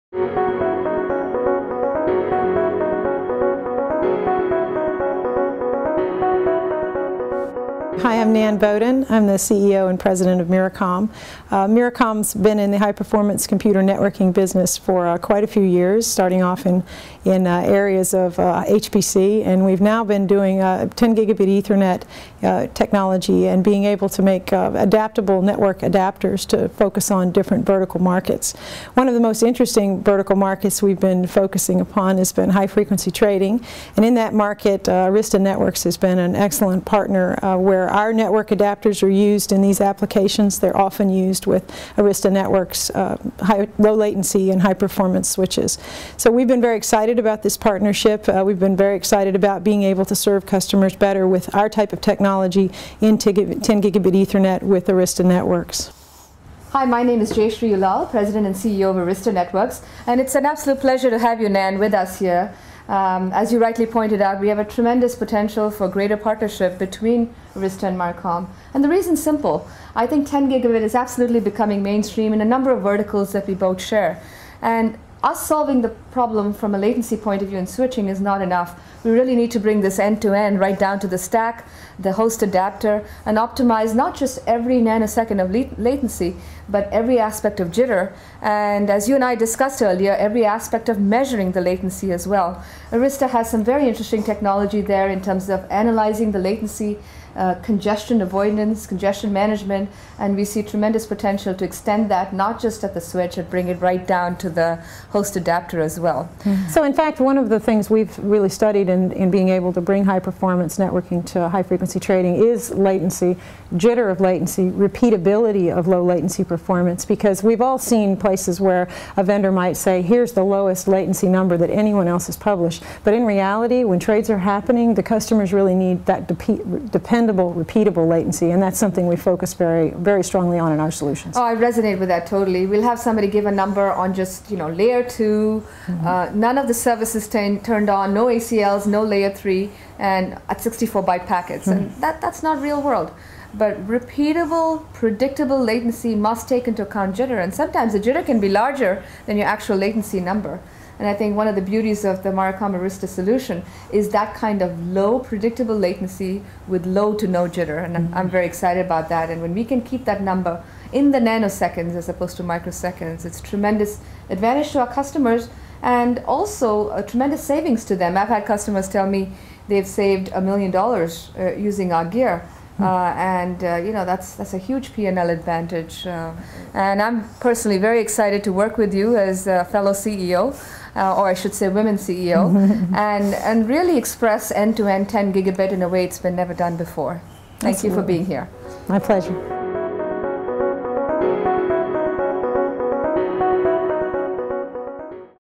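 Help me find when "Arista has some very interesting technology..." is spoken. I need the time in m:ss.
1:32.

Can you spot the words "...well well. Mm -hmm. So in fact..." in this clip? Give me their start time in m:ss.
1:45.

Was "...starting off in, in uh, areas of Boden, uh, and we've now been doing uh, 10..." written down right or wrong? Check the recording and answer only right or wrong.
wrong.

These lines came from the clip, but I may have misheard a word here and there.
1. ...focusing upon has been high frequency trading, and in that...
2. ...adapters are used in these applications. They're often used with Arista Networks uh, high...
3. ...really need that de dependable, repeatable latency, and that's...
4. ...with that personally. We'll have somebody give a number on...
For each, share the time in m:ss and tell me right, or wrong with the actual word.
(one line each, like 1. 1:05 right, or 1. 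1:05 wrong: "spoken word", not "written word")
1. 0:31 right
2. 0:38 right
3. 2:05 right
4. 2:12 wrong: "totally", not "personally".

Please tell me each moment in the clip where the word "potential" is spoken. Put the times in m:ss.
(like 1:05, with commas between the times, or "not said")
1:05, 1:41.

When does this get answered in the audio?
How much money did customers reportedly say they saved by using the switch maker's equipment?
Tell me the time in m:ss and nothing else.
2:50.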